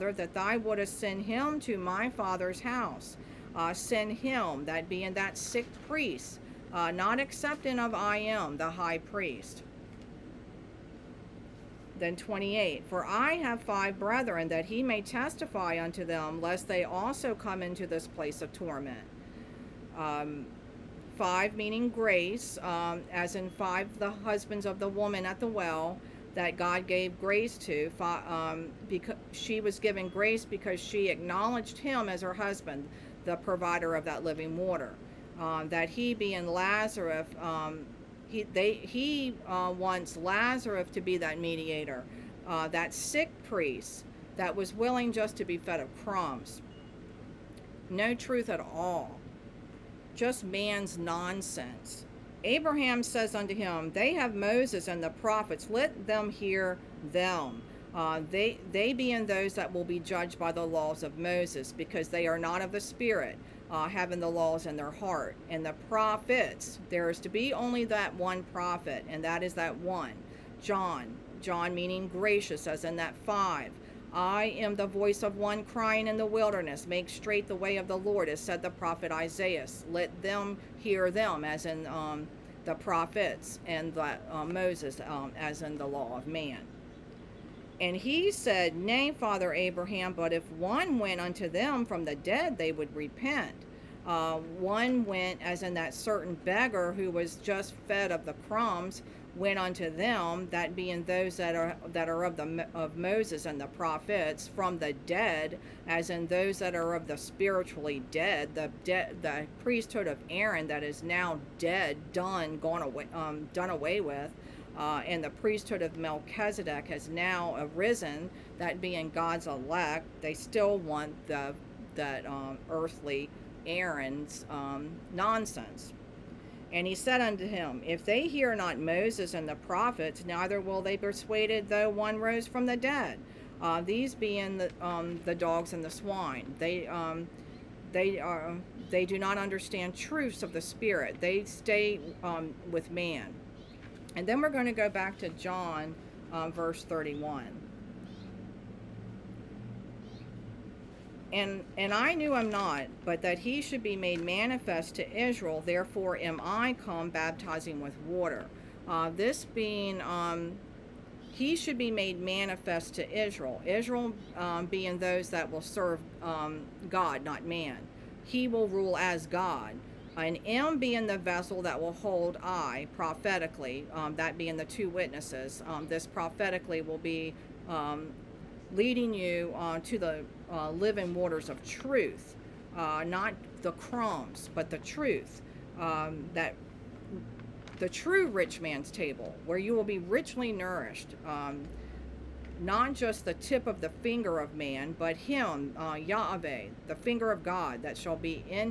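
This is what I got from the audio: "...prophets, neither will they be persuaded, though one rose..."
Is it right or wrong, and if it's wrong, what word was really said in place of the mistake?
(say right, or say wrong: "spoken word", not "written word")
right.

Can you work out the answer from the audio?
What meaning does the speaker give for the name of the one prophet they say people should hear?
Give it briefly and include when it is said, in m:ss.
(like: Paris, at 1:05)
Gracious, at 1:11.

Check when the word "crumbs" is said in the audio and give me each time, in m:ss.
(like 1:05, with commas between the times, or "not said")
0:46, 1:38, 3:03.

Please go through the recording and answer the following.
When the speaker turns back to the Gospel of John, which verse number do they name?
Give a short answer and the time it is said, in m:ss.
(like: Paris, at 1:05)
31, at 2:26.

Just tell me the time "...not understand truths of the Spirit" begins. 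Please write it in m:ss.
2:19.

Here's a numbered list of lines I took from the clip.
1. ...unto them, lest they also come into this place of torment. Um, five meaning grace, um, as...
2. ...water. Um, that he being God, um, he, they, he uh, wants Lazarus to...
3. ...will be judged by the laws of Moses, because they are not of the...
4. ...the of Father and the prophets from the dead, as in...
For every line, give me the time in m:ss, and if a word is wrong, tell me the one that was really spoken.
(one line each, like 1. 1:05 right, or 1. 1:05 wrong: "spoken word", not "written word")
1. 0:15 right
2. 0:34 wrong: "Lazarus", not "God"
3. 0:59 right
4. 1:42 wrong: "Moses", not "Father".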